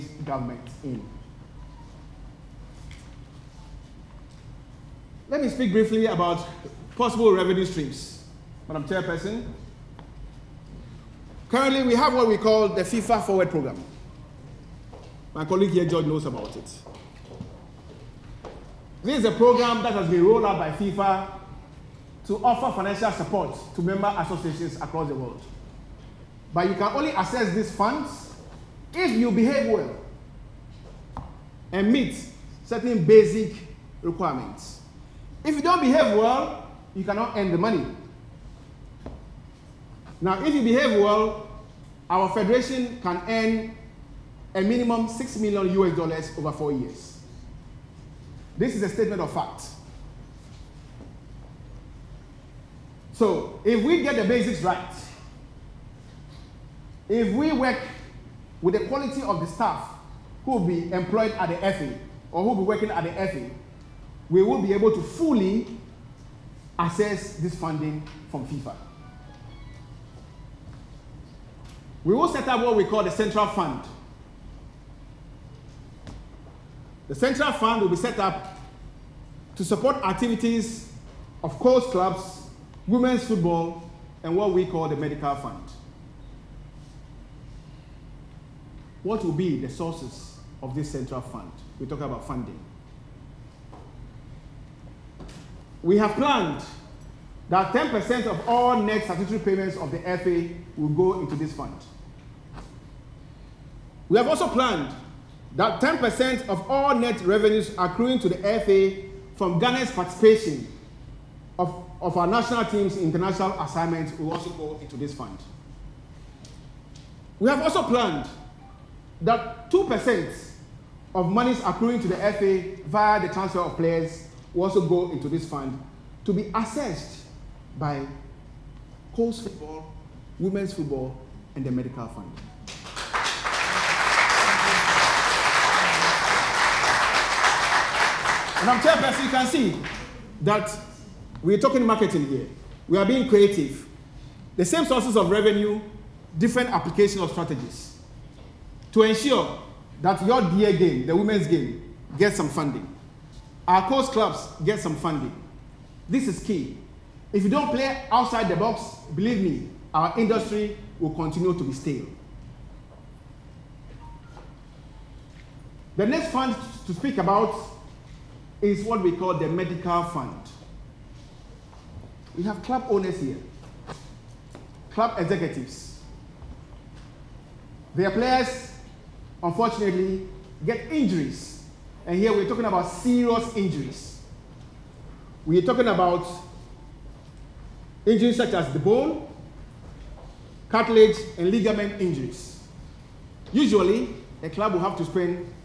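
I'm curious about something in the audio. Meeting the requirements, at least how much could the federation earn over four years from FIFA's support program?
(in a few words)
6 million US dollars.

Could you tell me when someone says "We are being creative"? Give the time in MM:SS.
02:22.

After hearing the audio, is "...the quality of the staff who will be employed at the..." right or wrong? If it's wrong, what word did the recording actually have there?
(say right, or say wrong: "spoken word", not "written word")
right.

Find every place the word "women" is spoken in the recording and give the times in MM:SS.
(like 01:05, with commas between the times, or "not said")
01:22, 02:10, 02:31.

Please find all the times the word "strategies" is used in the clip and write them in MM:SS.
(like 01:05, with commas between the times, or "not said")
02:27.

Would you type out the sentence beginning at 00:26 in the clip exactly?
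But you can only access these funds if you behave well and meet certain basic requirements.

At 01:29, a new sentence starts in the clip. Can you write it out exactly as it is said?
What will be the sources of this central fund?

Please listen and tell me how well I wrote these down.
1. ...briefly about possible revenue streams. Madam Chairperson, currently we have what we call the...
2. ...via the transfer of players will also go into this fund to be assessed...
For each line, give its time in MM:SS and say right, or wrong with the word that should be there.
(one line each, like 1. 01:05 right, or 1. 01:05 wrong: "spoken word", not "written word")
1. 00:05 right
2. 02:02 right.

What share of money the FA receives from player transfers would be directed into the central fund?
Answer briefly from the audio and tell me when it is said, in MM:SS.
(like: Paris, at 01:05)
2%, at 01:59.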